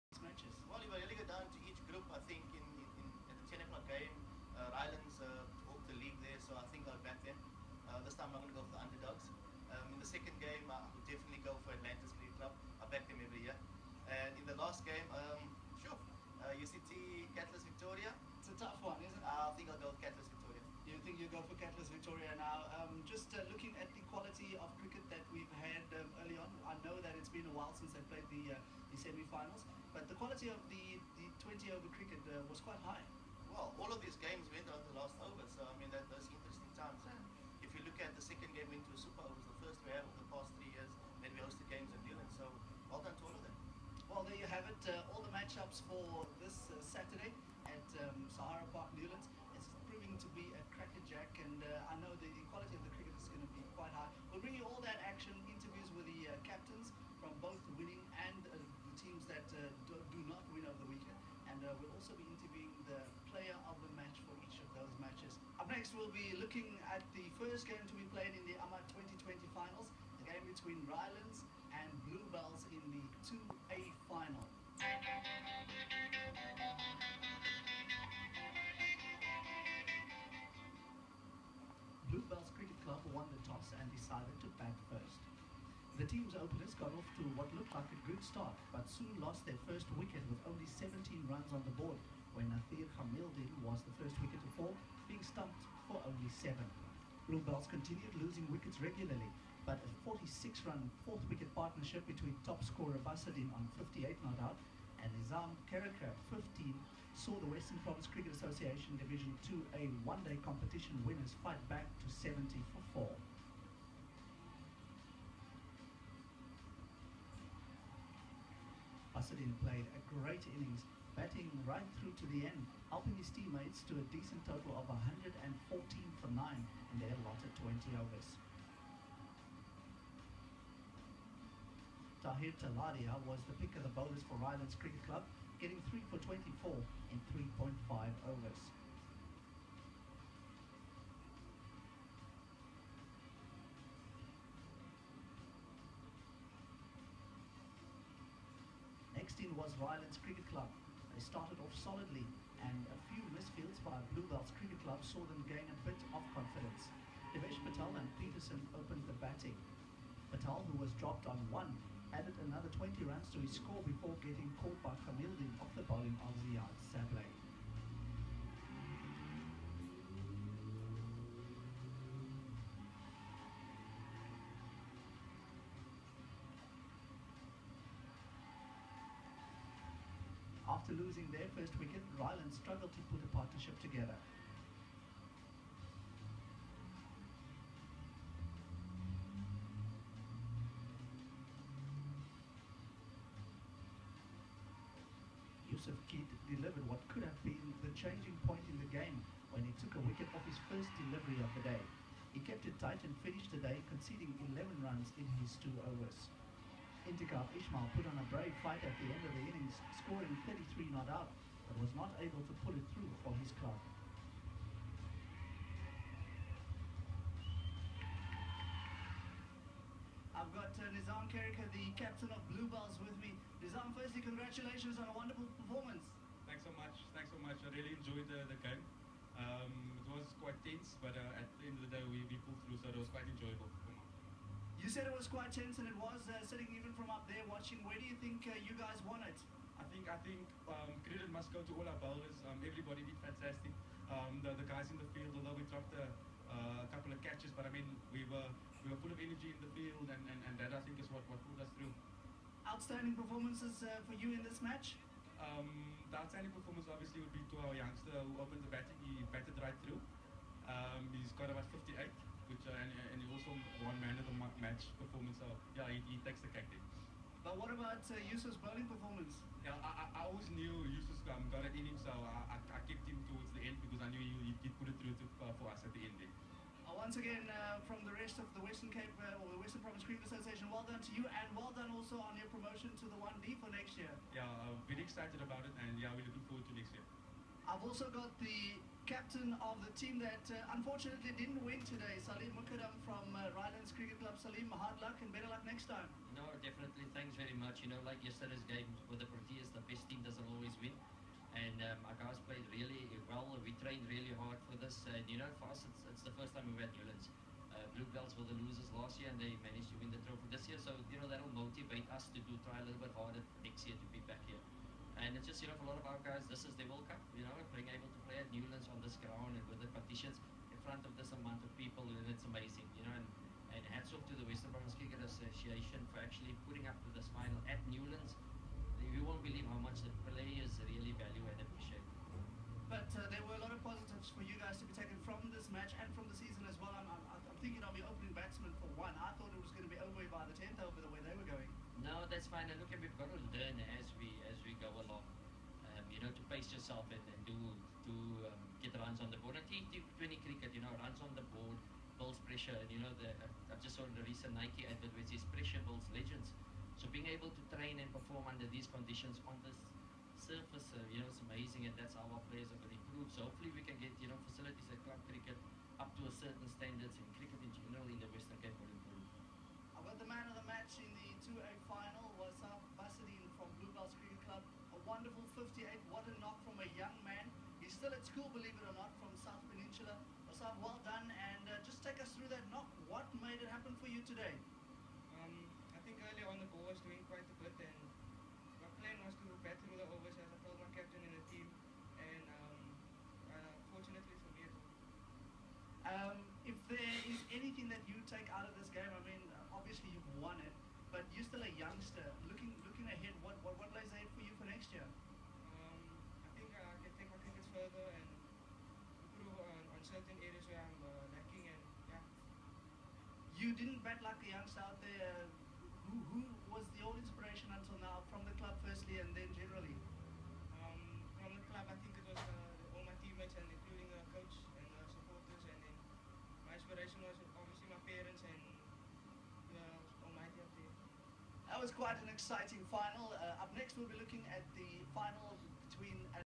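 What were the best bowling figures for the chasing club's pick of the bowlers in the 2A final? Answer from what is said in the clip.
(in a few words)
3 for 24.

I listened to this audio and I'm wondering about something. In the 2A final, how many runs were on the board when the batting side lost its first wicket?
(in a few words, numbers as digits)
17.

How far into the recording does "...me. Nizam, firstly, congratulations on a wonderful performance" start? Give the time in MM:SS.
03:43.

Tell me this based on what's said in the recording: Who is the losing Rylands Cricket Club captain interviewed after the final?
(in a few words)
Salim Mukadam.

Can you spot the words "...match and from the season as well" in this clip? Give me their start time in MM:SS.
05:35.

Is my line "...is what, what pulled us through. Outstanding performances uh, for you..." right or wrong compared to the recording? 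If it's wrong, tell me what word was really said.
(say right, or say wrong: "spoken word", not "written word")
right.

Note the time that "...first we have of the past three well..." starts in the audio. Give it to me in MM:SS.
00:39.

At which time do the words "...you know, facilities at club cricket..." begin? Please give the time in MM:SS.
06:04.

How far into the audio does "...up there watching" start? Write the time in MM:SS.
03:57.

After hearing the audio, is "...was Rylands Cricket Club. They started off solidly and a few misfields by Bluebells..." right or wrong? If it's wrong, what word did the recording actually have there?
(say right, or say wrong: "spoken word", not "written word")
right.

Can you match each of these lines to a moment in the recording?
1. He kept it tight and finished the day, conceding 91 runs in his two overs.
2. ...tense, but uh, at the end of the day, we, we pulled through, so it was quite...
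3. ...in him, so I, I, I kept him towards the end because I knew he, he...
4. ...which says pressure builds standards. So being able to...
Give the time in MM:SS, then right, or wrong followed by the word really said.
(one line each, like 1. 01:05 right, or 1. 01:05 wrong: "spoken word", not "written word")
1. 03:22 wrong: "11", not "91"
2. 03:50 right
3. 04:31 right
4. 05:55 wrong: "legends", not "standards".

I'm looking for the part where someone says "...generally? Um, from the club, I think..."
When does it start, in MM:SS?
06:59.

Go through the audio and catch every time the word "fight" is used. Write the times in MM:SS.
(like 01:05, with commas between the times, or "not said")
01:51, 03:28.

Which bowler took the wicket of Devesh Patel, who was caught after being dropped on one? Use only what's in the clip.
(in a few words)
Ziad Sablé.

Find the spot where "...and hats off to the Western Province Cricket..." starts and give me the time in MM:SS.
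05:23.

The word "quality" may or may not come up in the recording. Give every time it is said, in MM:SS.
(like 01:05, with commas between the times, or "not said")
00:24, 00:30, 00:52.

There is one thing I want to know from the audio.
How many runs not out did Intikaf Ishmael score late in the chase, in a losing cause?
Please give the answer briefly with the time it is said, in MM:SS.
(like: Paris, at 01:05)
33, at 03:30.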